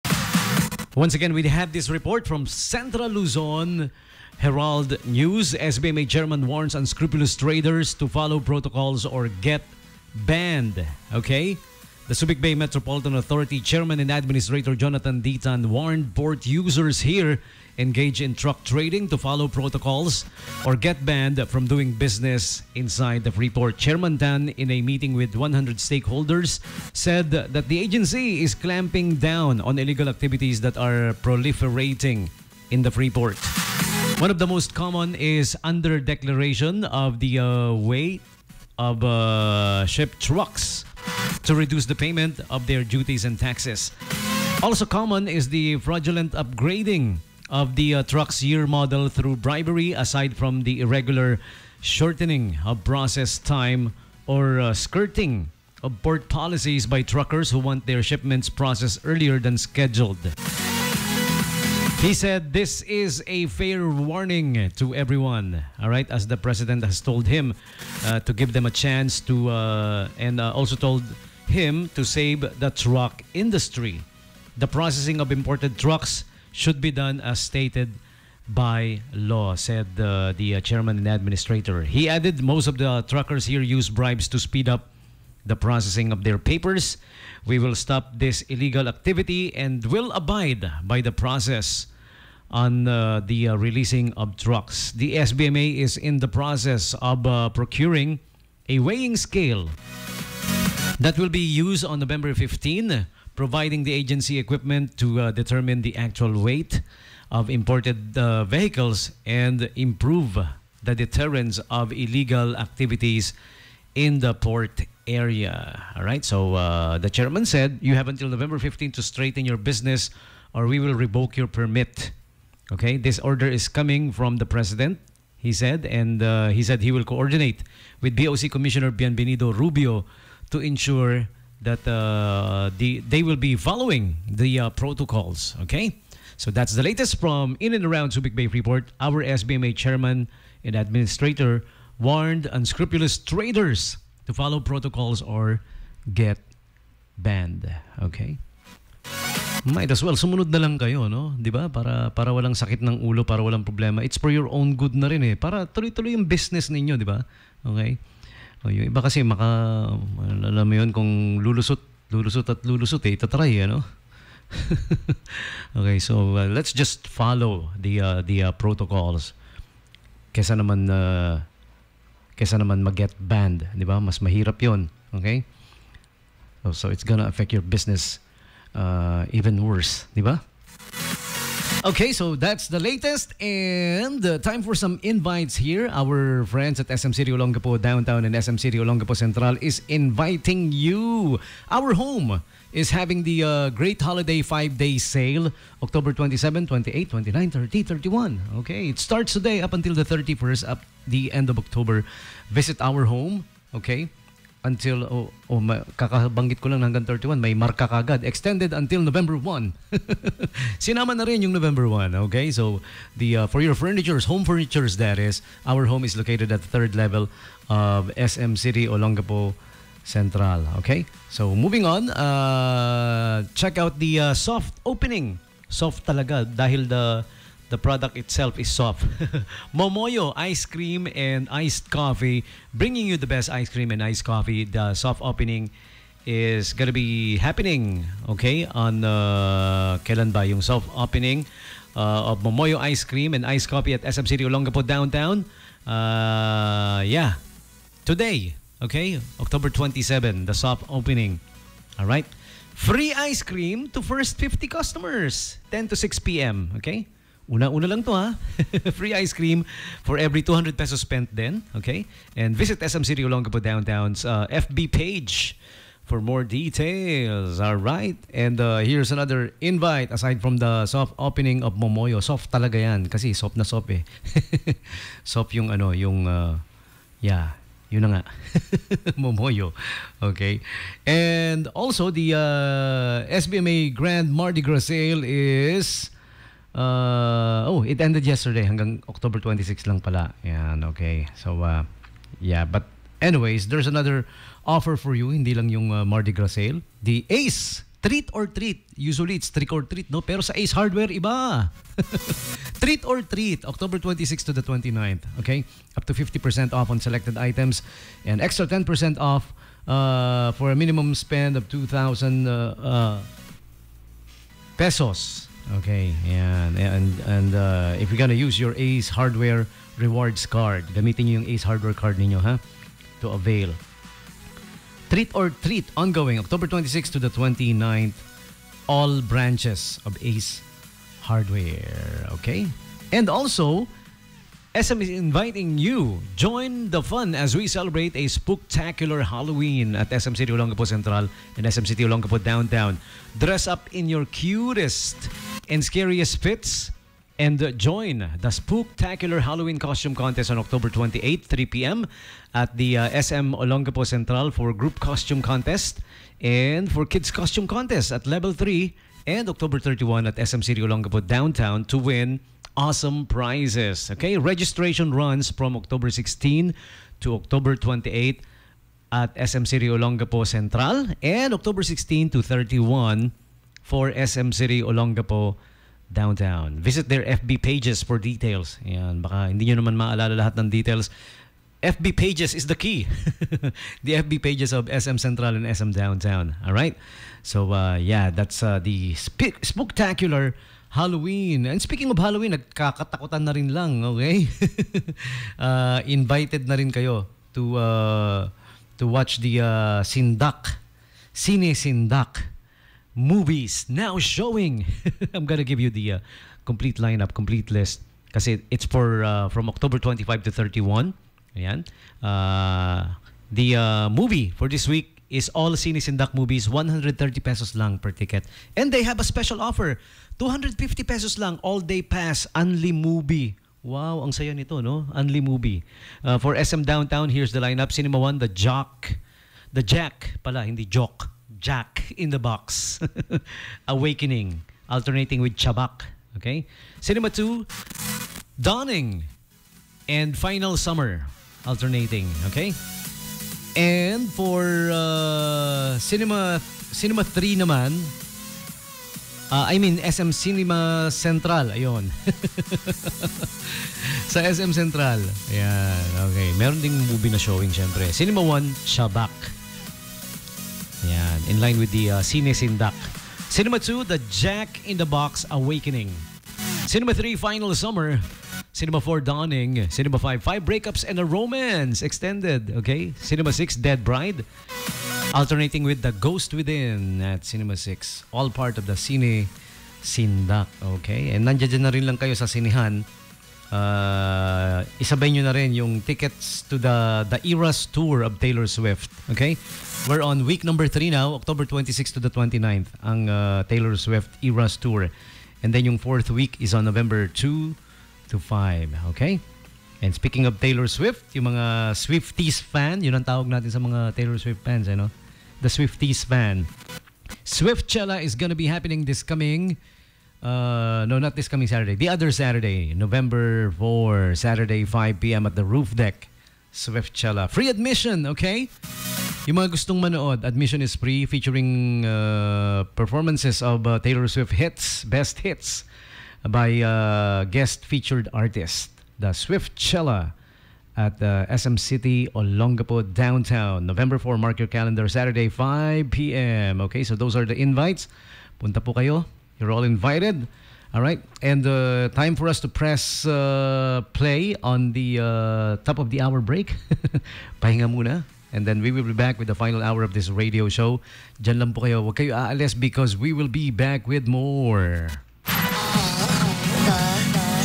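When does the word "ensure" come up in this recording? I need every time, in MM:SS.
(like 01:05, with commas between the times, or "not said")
02:10.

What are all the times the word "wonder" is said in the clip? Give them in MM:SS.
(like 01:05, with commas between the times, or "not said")
not said.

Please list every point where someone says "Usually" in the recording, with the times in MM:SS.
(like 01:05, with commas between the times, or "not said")
04:58.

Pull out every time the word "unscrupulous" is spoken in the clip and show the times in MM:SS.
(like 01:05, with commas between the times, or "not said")
00:06, 02:22.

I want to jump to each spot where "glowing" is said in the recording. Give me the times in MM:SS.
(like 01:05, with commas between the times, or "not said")
not said.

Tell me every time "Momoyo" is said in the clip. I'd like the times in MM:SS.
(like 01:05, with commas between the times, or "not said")
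03:49, 04:02, 04:31, 04:39.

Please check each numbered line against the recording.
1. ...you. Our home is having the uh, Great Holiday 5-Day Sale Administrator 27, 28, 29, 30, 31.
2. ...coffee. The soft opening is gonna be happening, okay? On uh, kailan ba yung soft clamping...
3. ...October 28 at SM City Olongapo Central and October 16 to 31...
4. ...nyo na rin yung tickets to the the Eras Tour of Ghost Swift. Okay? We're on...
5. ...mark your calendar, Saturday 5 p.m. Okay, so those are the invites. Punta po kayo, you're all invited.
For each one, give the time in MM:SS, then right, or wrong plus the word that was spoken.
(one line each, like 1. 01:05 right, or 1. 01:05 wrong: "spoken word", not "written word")
1. 03:10 wrong: "October", not "Administrator"
2. 03:54 wrong: "opening", not "clamping"
3. 06:07 right
4. 08:05 wrong: "Taylor", not "Ghost"
5. 08:54 right.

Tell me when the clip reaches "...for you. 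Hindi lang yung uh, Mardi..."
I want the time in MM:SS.
04:54.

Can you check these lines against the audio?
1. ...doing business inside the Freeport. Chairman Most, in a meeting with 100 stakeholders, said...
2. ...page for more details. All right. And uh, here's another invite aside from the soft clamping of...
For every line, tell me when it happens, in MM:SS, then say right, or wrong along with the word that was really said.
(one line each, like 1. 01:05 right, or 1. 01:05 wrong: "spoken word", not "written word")
1. 00:21 wrong: "Tan", not "Most"
2. 04:24 wrong: "opening", not "clamping".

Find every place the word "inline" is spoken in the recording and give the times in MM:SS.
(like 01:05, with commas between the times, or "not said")
not said.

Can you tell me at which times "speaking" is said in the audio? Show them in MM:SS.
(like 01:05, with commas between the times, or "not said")
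06:31, 08:20.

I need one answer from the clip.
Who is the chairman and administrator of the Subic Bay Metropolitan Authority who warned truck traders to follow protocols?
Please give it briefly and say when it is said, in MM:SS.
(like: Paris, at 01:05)
Jonathan D. Tan, at 00:14.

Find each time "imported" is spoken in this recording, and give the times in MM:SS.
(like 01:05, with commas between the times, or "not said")
01:15, 01:47.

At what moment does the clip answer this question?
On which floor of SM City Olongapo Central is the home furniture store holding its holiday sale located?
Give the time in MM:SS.
03:36.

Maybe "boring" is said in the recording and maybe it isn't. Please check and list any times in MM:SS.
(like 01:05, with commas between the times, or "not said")
not said.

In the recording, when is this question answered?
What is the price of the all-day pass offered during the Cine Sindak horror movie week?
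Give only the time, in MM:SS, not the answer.
07:00.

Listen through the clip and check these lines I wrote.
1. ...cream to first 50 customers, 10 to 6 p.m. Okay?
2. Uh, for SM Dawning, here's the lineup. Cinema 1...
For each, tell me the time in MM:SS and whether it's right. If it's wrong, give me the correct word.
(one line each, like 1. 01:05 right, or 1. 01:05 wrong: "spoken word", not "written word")
1. 04:13 right
2. 07:06 wrong: "Downtown", not "Dawning".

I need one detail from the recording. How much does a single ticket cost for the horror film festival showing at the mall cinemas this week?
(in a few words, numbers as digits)
130 pesos.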